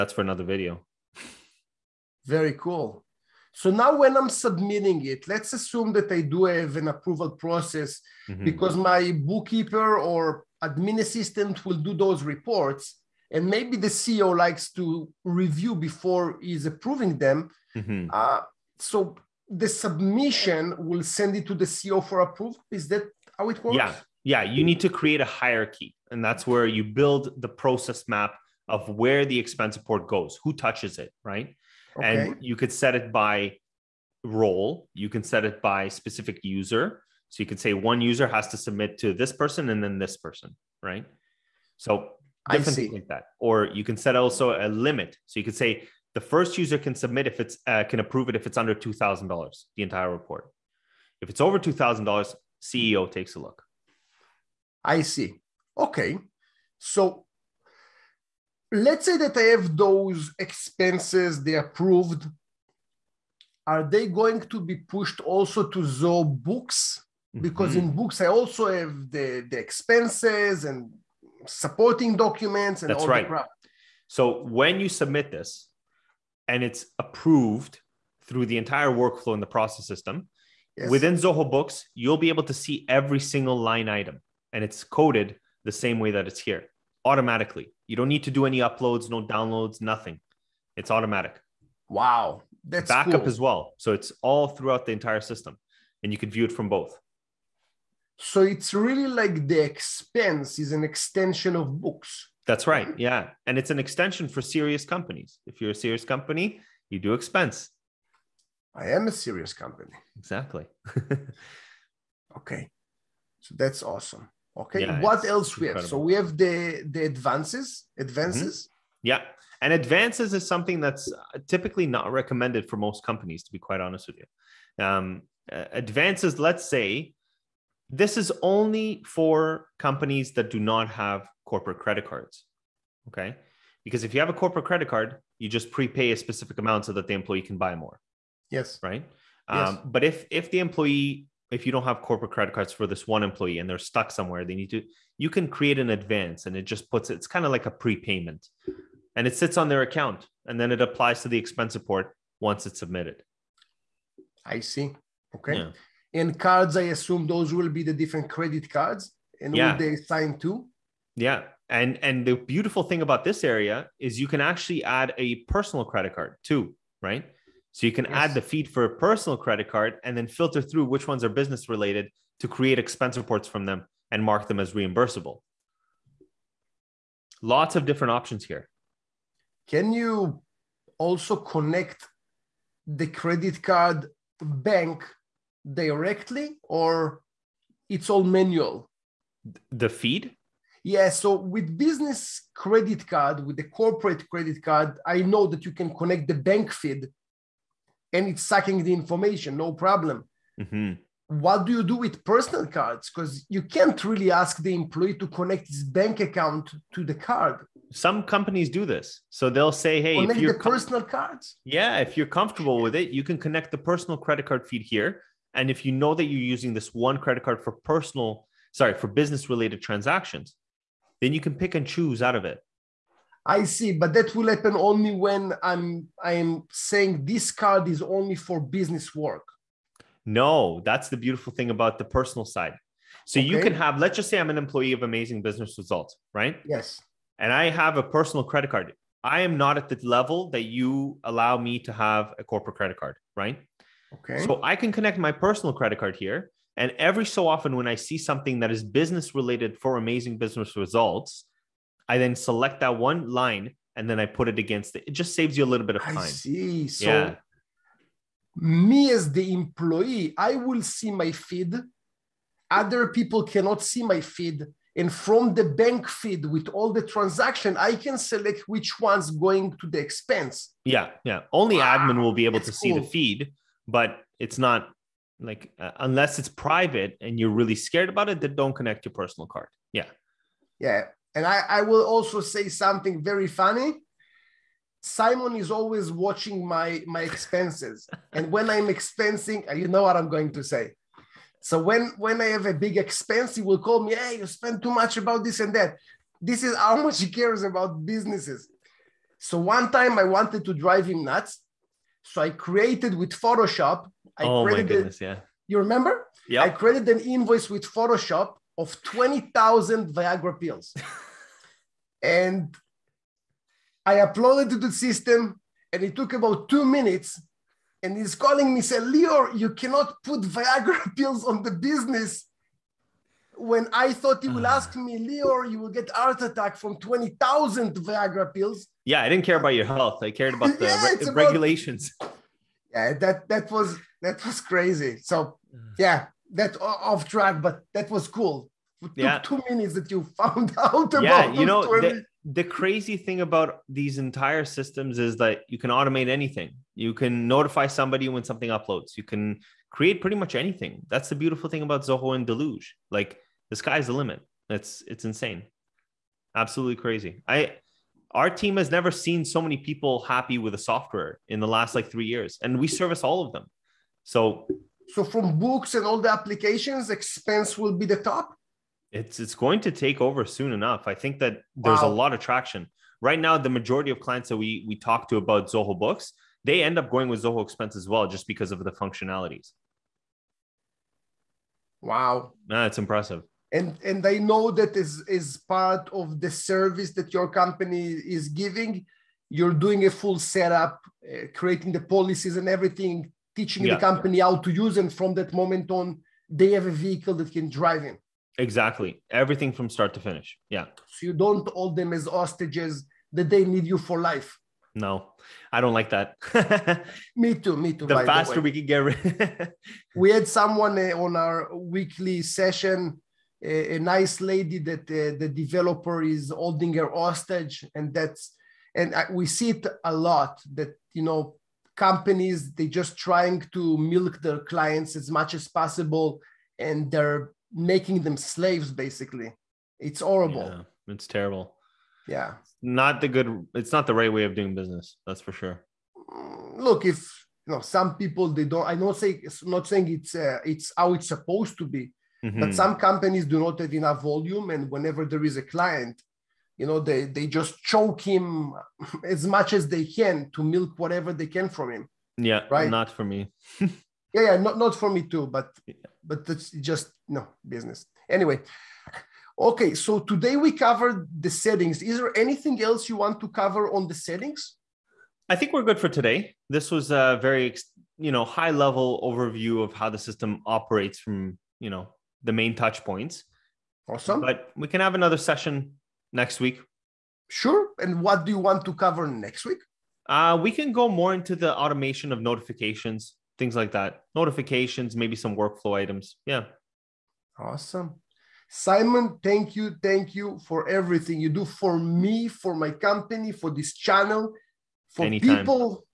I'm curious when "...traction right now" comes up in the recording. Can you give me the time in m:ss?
6:12.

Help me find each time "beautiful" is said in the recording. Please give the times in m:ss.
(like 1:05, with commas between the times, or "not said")
2:42, 3:51, 5:51.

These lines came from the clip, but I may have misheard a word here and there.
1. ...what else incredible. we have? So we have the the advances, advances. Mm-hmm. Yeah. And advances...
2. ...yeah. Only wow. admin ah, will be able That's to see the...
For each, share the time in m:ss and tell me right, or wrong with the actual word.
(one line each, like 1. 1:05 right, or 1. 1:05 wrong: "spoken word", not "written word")
1. 1:54 right
2. 4:31 right.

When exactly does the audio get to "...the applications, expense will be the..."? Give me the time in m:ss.
6:06.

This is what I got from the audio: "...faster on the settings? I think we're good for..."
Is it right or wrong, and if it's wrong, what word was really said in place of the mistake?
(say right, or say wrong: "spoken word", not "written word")
wrong: "cover", not "faster".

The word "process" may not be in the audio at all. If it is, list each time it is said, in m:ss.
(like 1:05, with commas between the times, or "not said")
0:07, 0:27, 1:19.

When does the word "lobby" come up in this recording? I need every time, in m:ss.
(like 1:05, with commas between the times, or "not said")
not said.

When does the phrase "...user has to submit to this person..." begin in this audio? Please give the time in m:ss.
0:37.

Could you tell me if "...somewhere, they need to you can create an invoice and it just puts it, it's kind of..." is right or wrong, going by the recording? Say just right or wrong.
wrong.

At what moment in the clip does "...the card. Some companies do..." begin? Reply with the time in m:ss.
3:27.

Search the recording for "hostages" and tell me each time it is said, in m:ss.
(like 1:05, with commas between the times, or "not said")
6:42, 6:57.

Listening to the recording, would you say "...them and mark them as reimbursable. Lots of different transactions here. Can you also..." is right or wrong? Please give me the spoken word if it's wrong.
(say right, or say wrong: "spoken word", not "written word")
wrong: "options", not "transactions".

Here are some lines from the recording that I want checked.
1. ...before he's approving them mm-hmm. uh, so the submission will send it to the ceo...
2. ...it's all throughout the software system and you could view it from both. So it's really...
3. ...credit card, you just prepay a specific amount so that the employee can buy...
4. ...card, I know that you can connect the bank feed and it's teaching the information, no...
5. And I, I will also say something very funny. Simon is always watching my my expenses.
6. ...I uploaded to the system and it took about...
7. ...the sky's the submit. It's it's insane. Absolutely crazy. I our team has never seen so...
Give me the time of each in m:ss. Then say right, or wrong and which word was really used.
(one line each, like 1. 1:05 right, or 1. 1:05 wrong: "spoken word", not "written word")
1. 0:15 right
2. 1:33 wrong: "entire", not "software"
3. 2:14 right
4. 3:14 wrong: "sucking", not "teaching"
5. 4:41 right
6. 5:14 right
7. 5:53 wrong: "limit", not "submit".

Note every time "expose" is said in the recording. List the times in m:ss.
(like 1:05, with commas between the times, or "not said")
not said.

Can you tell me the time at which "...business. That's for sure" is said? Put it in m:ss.
7:14.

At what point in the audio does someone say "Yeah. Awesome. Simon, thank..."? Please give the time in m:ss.
8:06.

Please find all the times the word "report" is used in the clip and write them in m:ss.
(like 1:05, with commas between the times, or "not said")
0:12, 0:29, 0:50, 2:31, 2:53.